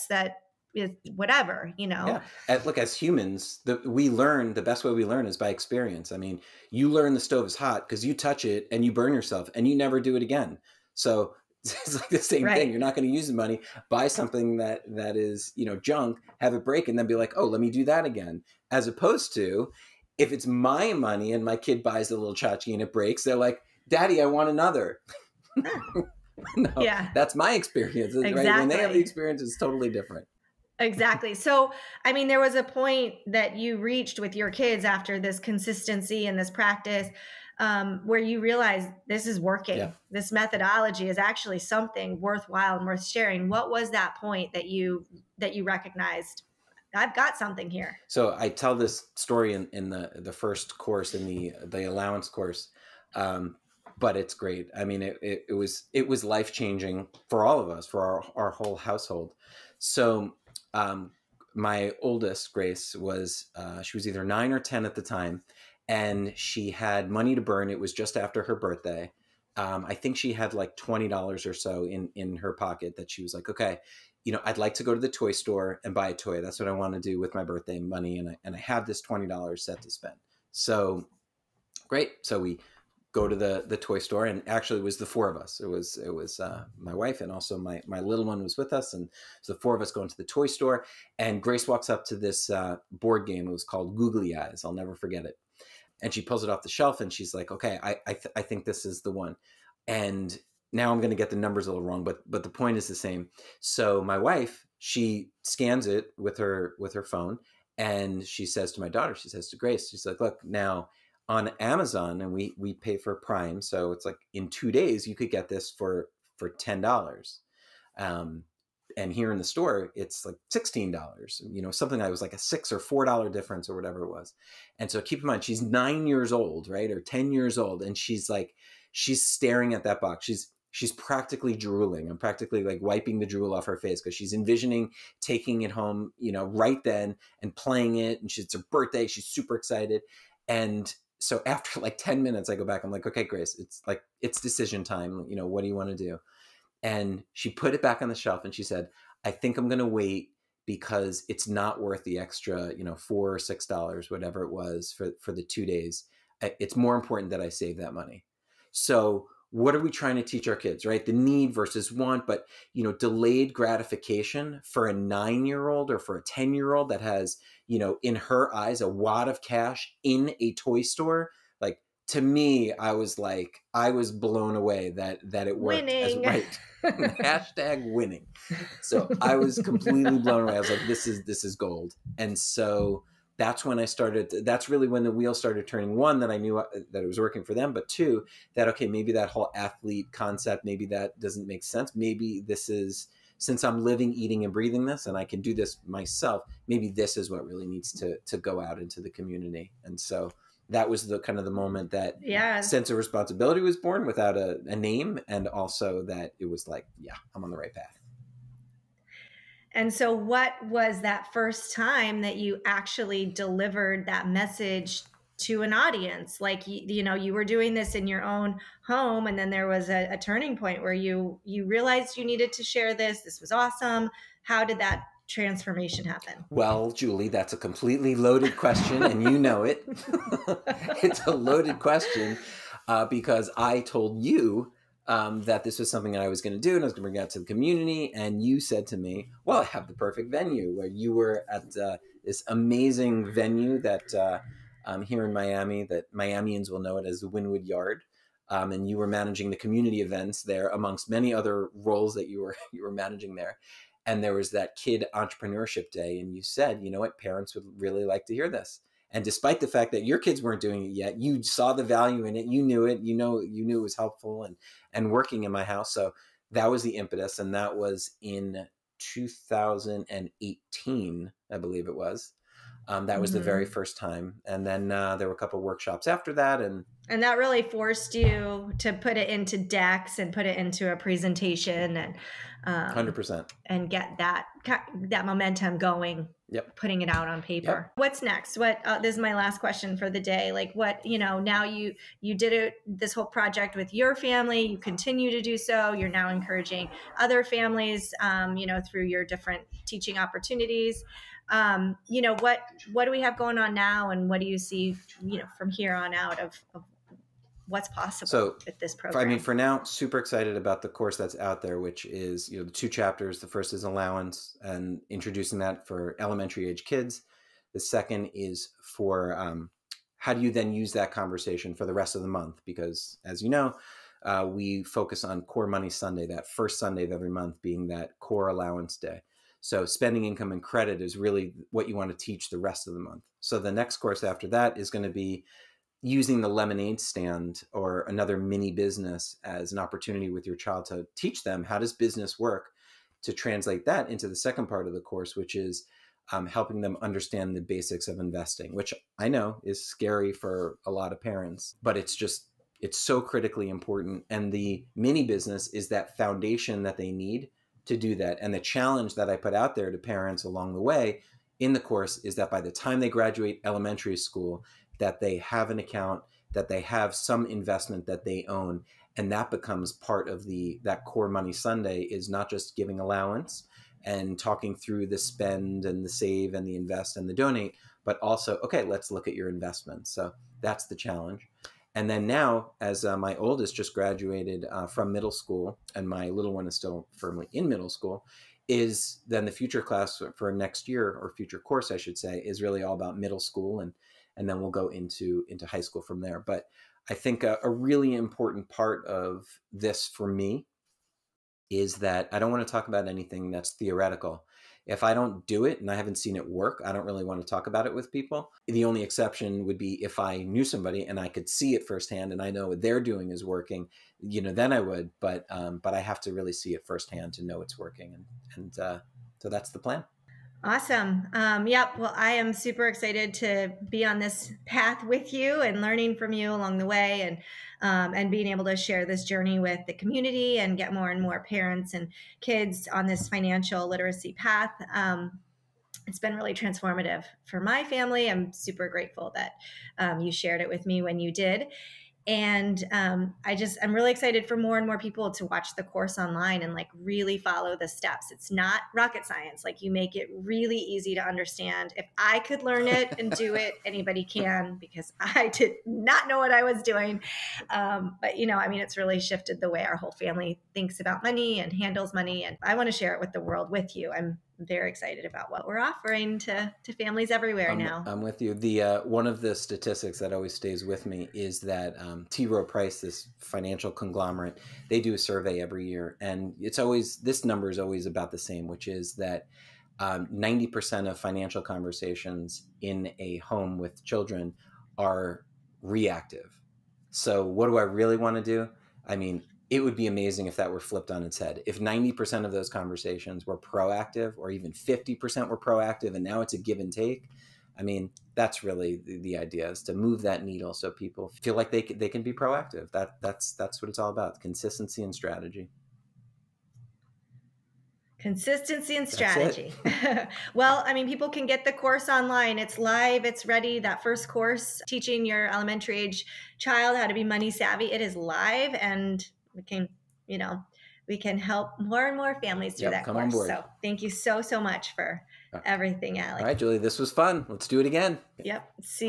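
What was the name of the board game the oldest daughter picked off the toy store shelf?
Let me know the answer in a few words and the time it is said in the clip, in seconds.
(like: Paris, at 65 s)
Googly Eyes, at 93 s.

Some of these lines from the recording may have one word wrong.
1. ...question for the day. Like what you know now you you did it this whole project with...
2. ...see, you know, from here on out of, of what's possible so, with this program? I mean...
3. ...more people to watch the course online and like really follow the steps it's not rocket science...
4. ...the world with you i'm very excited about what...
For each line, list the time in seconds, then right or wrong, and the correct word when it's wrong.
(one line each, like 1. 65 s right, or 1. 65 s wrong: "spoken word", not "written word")
1. 289 s right
2. 304 s right
3. 444 s right
4. 463 s right.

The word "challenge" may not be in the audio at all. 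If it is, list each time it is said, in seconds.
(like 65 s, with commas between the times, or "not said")
358 s, 380 s.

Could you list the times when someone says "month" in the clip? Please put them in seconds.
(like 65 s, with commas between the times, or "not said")
322 s, 327 s, 332 s.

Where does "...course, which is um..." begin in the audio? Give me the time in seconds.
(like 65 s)
345 s.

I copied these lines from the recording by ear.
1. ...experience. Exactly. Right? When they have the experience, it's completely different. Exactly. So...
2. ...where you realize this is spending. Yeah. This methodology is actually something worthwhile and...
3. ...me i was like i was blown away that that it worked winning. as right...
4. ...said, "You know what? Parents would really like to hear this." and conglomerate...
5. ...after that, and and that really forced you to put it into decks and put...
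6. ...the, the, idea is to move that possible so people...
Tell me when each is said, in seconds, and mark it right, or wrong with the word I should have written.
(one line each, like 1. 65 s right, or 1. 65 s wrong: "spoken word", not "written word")
1. 27 s wrong: "totally", not "completely"
2. 38 s wrong: "working", not "spending"
3. 172 s right
4. 256 s wrong: "despite", not "conglomerate"
5. 276 s right
6. 499 s wrong: "needle", not "possible".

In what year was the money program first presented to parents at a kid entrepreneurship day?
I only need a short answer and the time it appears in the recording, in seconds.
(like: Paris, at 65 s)
2018, at 268 s.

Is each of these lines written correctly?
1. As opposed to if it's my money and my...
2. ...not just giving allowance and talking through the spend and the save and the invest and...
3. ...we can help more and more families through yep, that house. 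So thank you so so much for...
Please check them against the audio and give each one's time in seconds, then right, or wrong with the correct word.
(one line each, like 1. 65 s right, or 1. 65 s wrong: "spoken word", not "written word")
1. 18 s right
2. 372 s right
3. 521 s wrong: "course", not "house".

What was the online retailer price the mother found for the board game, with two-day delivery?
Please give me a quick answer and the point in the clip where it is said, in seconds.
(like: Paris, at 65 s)
$10, at 116 s.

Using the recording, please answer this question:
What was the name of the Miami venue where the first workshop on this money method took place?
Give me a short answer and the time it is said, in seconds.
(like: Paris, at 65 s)
Wynwood Yard, at 247 s.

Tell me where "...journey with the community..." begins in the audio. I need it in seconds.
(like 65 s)
429 s.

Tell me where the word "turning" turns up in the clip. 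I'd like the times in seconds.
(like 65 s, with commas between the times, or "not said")
185 s, 220 s.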